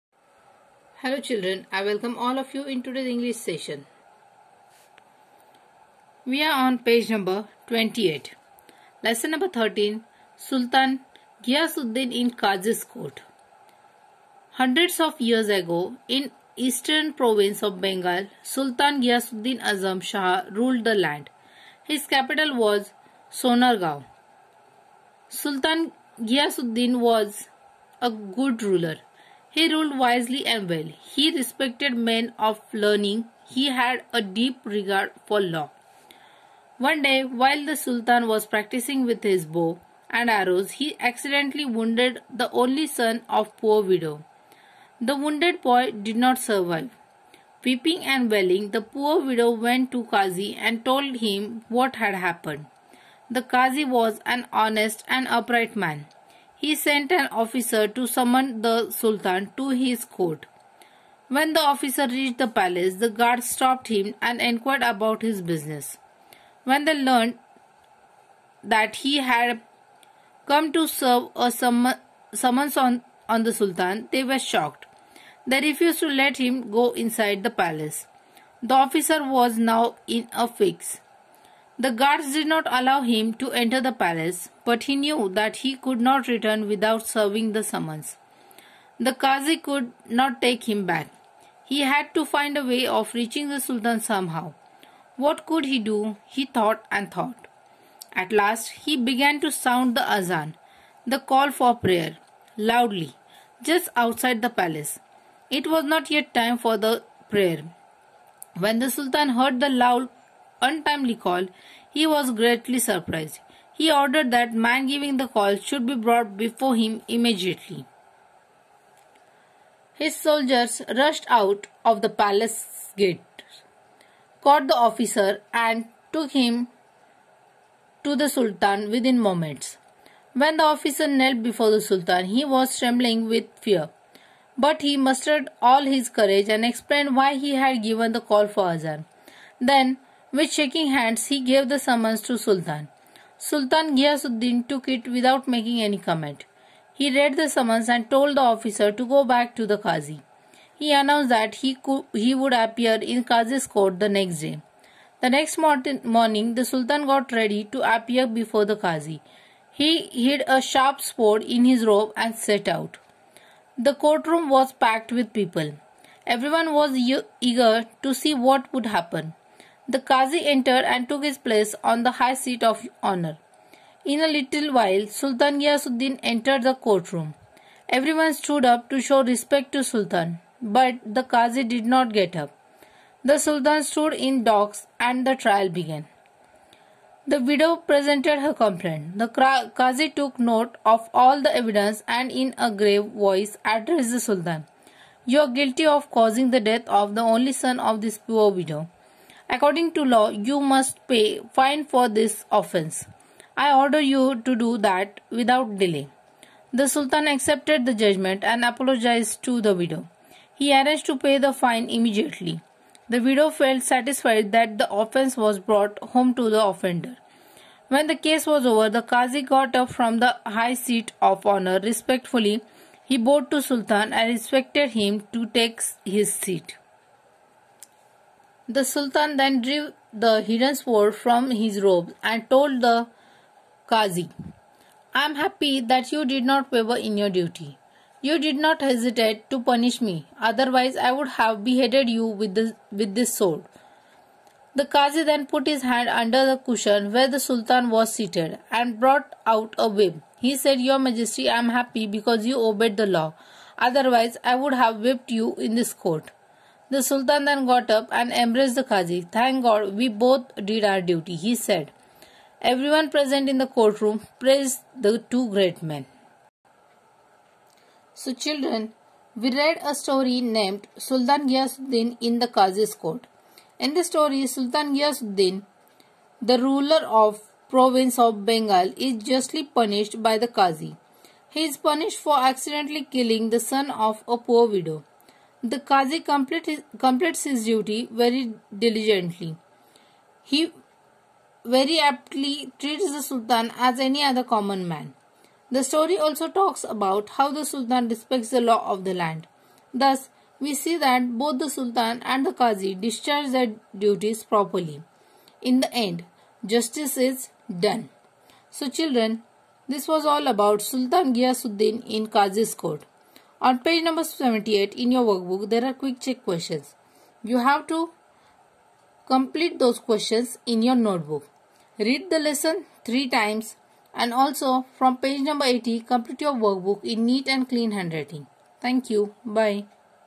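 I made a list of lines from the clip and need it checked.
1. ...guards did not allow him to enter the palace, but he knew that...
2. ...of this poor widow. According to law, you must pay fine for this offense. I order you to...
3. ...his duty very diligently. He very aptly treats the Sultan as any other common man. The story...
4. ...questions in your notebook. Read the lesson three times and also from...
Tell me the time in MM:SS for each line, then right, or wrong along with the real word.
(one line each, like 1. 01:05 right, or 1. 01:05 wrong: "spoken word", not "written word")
1. 01:21 right
2. 03:17 right
3. 04:47 right
4. 05:19 right.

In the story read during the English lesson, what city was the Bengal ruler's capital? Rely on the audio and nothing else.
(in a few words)
Sonargaon.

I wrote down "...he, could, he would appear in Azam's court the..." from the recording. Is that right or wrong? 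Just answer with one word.
wrong.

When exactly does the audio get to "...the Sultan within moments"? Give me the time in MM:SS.
02:08.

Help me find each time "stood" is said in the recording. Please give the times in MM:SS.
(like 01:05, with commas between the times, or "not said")
02:58, 03:03.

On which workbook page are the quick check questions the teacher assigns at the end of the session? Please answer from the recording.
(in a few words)
78.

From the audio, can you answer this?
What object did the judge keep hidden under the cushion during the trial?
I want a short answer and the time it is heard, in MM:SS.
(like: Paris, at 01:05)
A whip, at 04:09.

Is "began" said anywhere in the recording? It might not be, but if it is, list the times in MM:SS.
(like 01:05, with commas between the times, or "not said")
01:38, 03:05.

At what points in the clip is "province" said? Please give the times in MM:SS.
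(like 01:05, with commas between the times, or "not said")
00:17, 04:37.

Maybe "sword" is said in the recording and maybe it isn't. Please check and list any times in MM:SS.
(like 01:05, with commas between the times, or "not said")
02:41, 03:50, 04:03.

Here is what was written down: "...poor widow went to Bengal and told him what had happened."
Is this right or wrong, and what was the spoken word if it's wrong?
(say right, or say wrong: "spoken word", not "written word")
wrong: "Qazi", not "Bengal".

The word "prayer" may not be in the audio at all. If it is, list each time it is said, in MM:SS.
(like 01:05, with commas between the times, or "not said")
01:41, 01:47.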